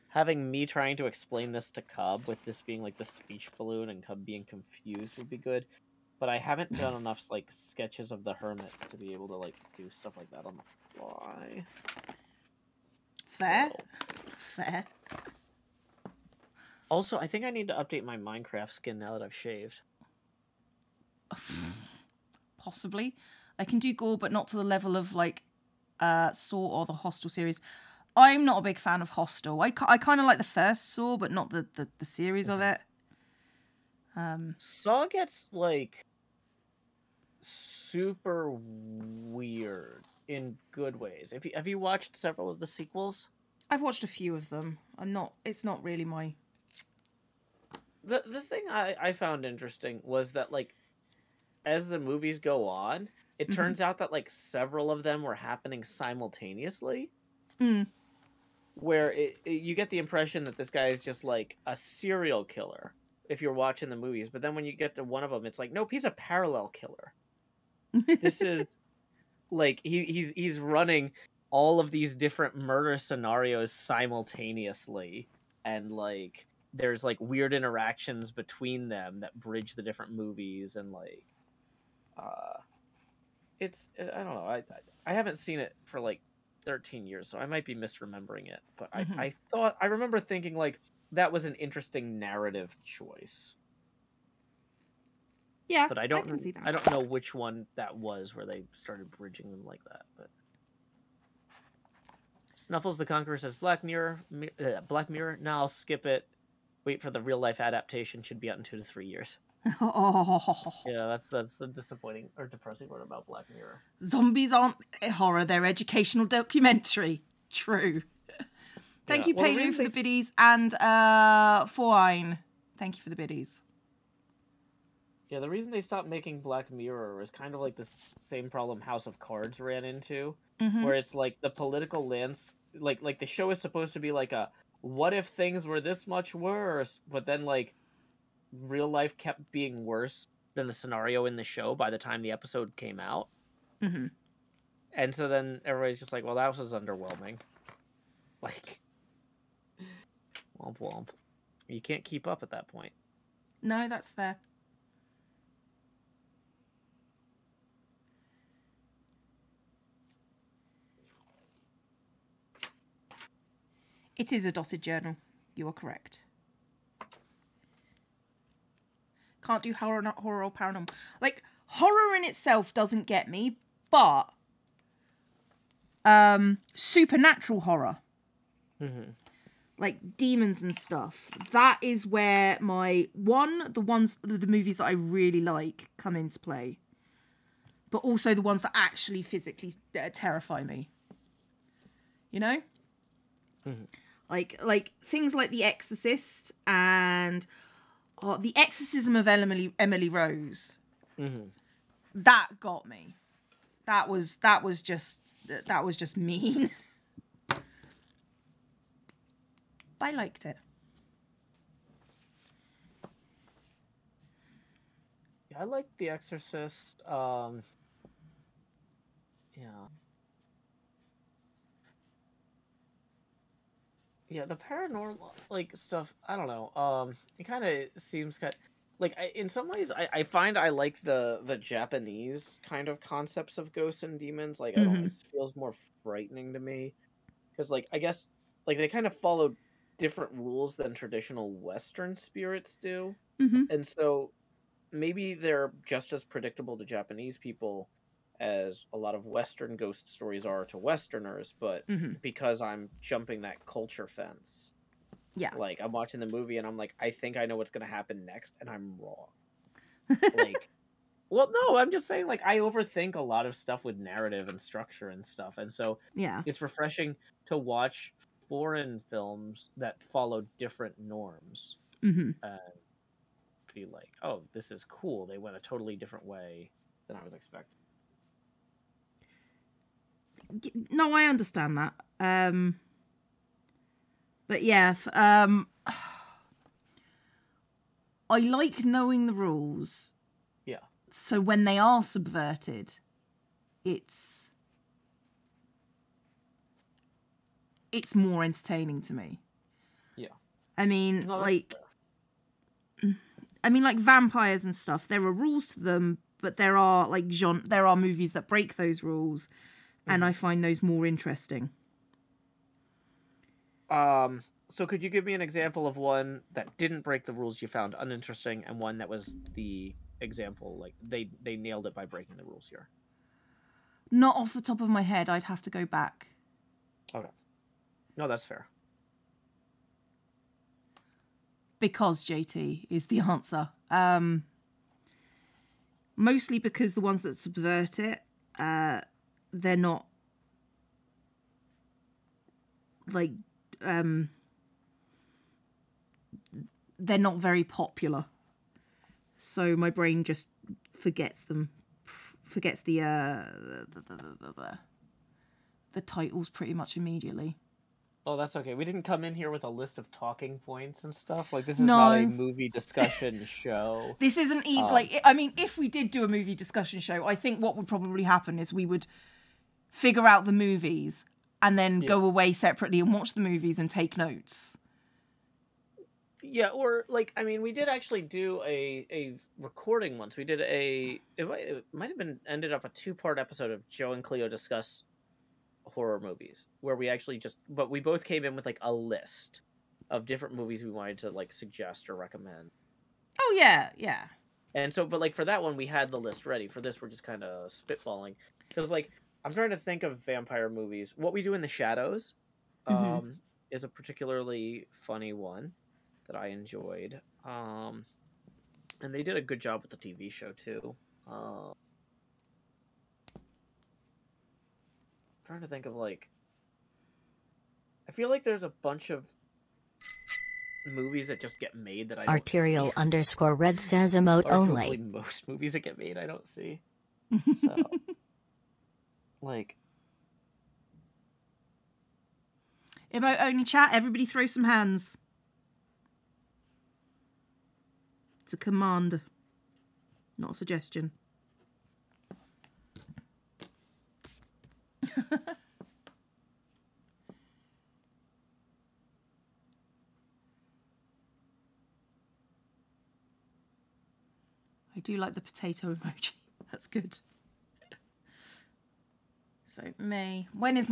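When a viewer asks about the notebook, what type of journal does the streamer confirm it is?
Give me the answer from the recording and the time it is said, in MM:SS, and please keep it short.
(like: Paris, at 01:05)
Dotted journal, at 02:44.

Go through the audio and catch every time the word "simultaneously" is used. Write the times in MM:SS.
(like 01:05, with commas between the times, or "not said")
00:55, 01:13.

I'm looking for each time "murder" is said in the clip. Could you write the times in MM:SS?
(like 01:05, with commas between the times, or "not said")
01:12.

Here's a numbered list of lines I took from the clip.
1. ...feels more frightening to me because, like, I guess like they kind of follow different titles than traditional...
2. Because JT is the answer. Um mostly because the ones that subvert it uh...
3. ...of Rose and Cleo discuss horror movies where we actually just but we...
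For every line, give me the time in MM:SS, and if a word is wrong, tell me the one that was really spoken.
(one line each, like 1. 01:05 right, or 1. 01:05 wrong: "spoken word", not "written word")
1. 03:55 wrong: "rules", not "titles"
2. 05:31 right
3. 06:23 wrong: "Joe", not "Rose".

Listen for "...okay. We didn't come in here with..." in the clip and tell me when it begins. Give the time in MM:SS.
05:58.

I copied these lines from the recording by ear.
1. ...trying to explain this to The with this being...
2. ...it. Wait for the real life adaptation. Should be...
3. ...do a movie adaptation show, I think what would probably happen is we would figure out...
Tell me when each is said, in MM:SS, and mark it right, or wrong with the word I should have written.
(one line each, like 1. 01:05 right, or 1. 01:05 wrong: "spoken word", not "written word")
1. 00:00 wrong: "Cub", not "The"
2. 01:46 right
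3. 06:06 wrong: "discussion", not "adaptation".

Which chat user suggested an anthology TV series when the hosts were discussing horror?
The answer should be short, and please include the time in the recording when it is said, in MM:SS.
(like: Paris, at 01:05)
Snuffles the Conqueror, at 01:42.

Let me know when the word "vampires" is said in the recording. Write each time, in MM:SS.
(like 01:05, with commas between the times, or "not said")
05:03, 06:40.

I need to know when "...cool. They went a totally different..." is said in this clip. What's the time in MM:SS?
04:34.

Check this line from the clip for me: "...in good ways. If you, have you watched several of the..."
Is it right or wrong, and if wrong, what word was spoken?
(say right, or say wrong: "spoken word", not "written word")
right.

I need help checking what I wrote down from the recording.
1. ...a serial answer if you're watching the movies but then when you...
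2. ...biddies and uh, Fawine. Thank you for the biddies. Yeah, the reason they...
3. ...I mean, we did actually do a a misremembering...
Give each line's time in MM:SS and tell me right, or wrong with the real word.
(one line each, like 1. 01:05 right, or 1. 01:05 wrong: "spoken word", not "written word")
1. 01:01 wrong: "killer", not "answer"
2. 01:59 right
3. 06:17 wrong: "recording", not "misremembering".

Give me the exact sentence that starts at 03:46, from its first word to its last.
Um, it kind of seems kind.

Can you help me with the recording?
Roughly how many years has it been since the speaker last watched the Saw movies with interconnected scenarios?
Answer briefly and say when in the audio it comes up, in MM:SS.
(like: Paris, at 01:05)
13, at 01:26.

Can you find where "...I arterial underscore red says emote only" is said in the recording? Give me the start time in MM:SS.
07:02.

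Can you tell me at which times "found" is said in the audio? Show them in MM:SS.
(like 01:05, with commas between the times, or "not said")
00:49, 05:17.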